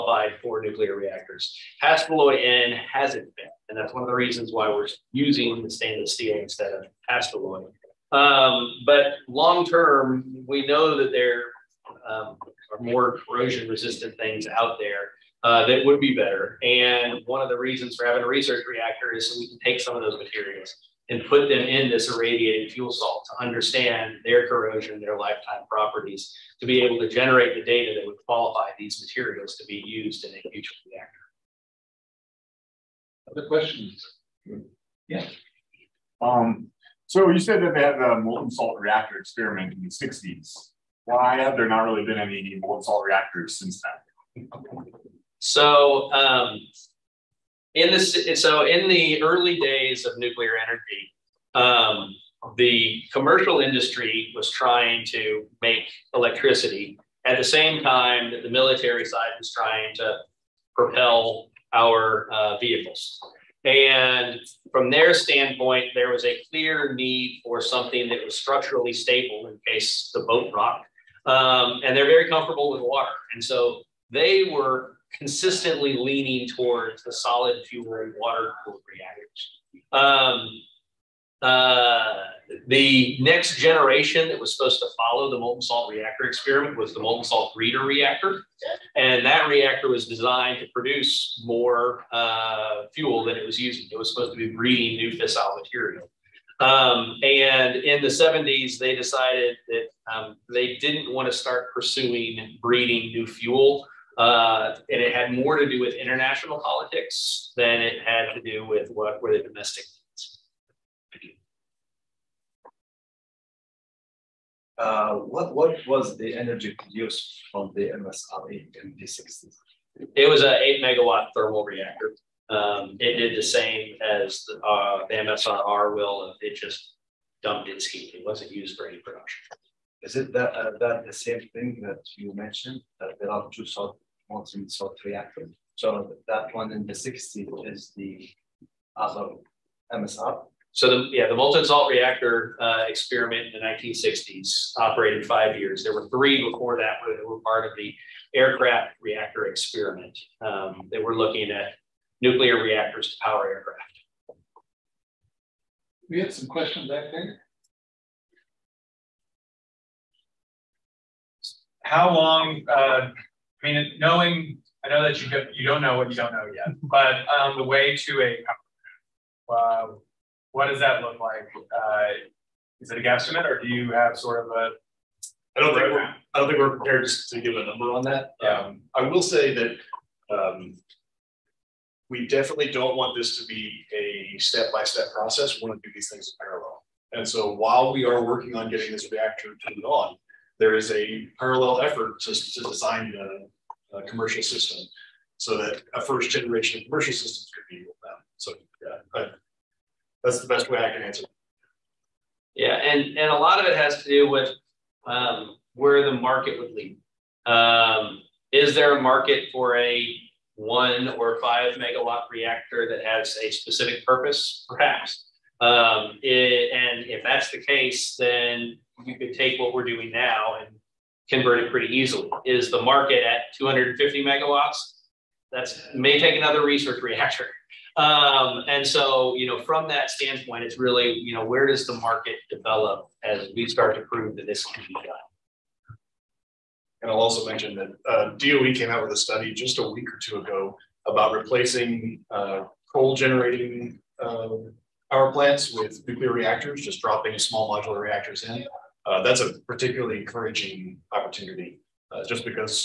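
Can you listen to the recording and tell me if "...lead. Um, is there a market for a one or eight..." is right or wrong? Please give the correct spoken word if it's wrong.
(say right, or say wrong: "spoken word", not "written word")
wrong: "five", not "eight".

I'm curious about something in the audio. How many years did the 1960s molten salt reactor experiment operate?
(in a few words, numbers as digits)
5 years.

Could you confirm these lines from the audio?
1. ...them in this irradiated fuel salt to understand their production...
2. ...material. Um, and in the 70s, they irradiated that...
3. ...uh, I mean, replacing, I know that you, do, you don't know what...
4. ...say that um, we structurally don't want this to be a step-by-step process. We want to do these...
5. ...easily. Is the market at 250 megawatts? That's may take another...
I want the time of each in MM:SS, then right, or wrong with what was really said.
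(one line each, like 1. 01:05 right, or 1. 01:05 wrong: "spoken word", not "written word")
1. 00:21 wrong: "corrosion", not "production"
2. 01:35 wrong: "decided", not "irradiated"
3. 02:42 wrong: "knowing", not "replacing"
4. 02:59 wrong: "definitely", not "structurally"
5. 03:41 right.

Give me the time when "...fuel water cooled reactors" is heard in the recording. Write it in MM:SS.
01:17.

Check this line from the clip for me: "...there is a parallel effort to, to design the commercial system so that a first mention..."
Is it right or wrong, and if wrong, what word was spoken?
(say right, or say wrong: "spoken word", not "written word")
wrong: "generation", not "mention".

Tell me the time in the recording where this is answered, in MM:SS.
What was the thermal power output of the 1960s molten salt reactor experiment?
02:00.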